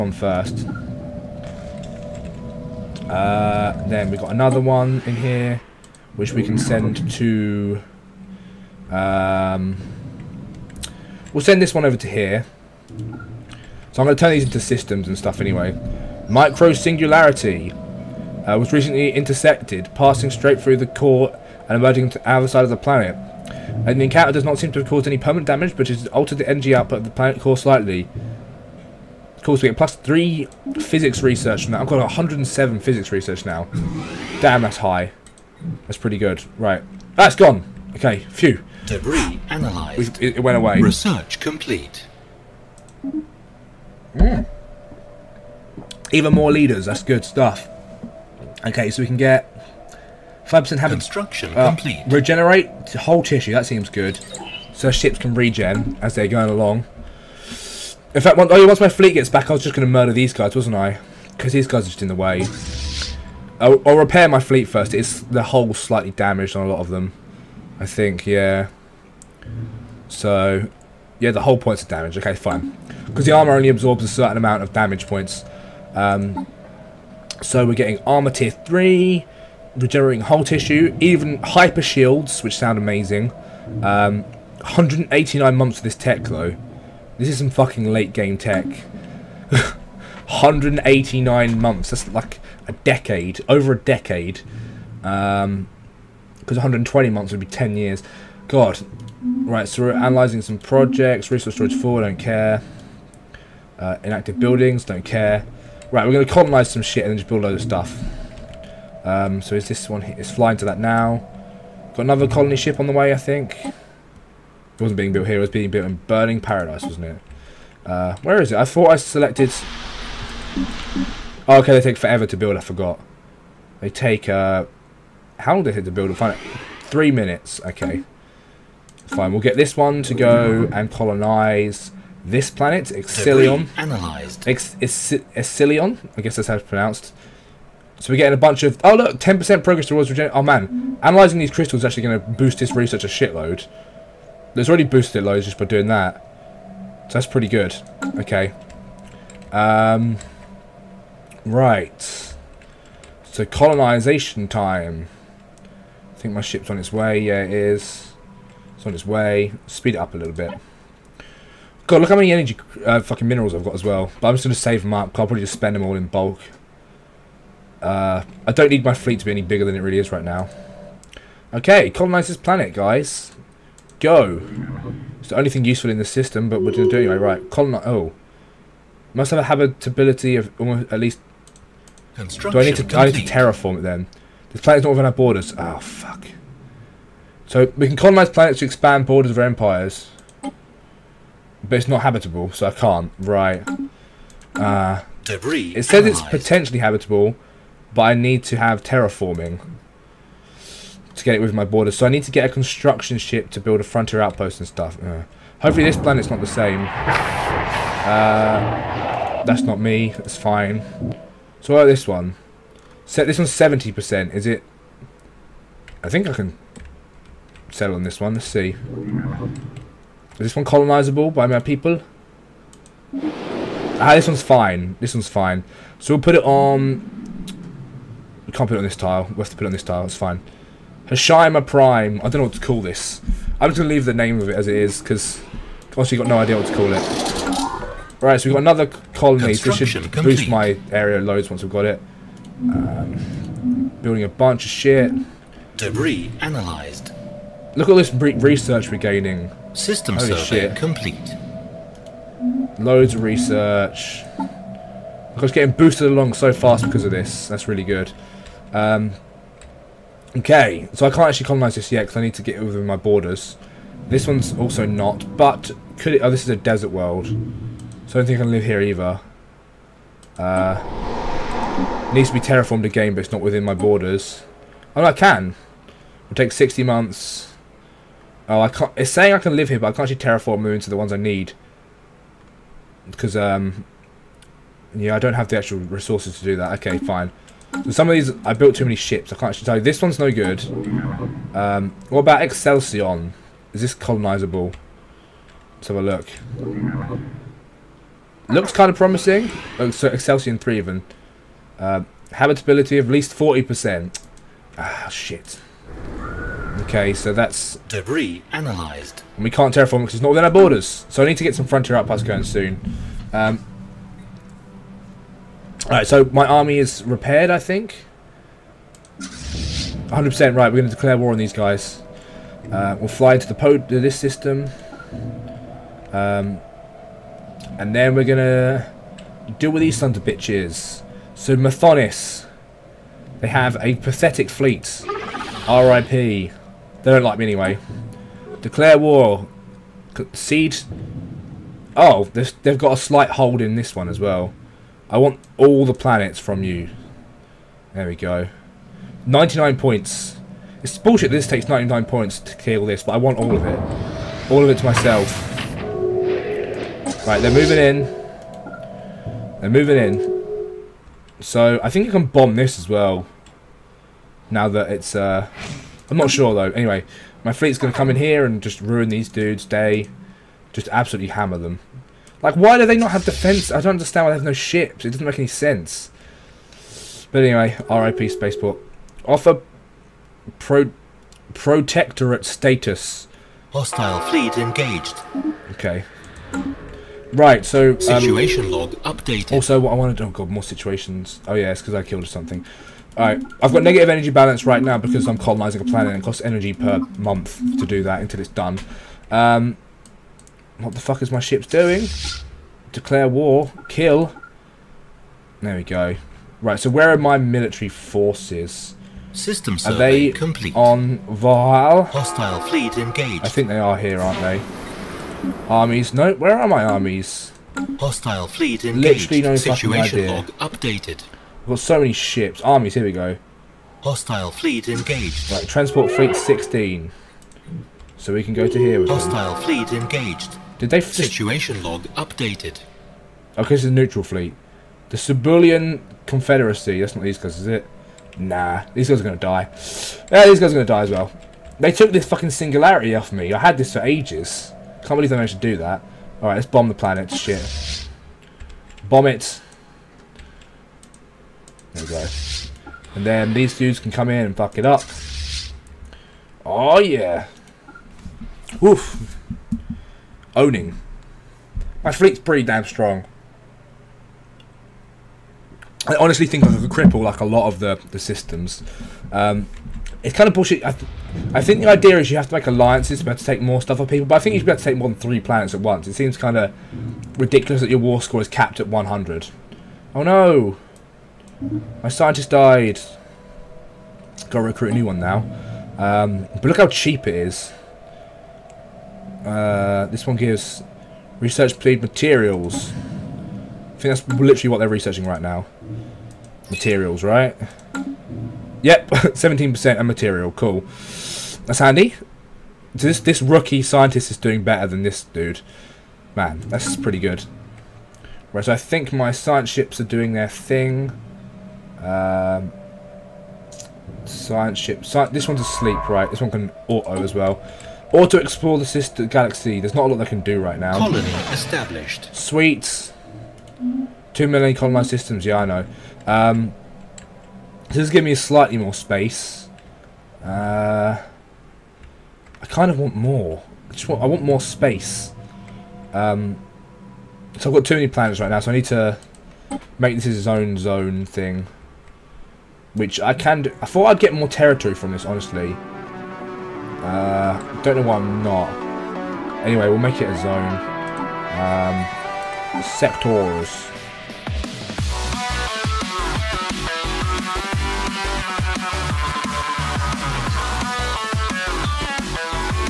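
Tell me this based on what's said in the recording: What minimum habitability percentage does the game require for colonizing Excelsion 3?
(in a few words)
40%.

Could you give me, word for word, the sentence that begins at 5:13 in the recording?
Um, Alright, so my army is repaired, I think.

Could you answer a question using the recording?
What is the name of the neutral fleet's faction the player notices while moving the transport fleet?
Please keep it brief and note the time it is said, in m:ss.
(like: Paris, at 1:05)
The Cebulian Confederacy, at 7:15.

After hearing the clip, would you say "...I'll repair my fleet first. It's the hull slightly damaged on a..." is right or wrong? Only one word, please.
right.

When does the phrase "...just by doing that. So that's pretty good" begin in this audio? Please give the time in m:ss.
2:25.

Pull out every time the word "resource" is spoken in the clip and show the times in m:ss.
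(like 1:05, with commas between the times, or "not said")
1:41, 4:45.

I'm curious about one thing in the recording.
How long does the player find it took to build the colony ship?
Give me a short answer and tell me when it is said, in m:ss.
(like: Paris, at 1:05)
3 minutes, at 2:06.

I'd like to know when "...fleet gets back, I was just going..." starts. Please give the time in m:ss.
0:58.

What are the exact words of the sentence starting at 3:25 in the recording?
Uh, hopefully this planet's not the same.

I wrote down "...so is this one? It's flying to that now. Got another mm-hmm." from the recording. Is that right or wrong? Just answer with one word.
right.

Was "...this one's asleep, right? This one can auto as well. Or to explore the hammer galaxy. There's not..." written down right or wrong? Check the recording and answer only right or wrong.
wrong.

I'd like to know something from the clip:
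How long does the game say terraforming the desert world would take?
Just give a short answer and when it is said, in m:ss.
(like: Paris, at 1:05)
60 months, at 4:36.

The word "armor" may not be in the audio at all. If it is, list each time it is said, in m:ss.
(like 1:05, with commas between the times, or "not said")
1:13, 1:17.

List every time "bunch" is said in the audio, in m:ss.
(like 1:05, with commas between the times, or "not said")
2:18, 4:04.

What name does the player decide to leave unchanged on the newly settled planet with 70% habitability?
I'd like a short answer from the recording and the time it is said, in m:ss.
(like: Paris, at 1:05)
Hashima Prime, at 3:51.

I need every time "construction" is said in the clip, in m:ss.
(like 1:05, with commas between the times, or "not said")
0:50, 3:22.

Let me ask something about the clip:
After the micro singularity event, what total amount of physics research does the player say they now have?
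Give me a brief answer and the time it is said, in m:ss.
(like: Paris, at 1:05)
107, at 0:31.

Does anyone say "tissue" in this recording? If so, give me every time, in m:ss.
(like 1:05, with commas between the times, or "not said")
0:53, 1:20.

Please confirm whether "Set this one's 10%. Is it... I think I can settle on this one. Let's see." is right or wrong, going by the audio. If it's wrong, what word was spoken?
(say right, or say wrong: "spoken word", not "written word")
wrong: "70", not "10".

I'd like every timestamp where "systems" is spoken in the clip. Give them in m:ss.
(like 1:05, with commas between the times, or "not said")
0:14, 2:56, 4:09, 5:24, 6:49, 7:48, 8:45.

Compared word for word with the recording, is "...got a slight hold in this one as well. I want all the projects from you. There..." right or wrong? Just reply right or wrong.
wrong.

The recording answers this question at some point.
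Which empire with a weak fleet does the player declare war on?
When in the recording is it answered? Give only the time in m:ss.
5:31.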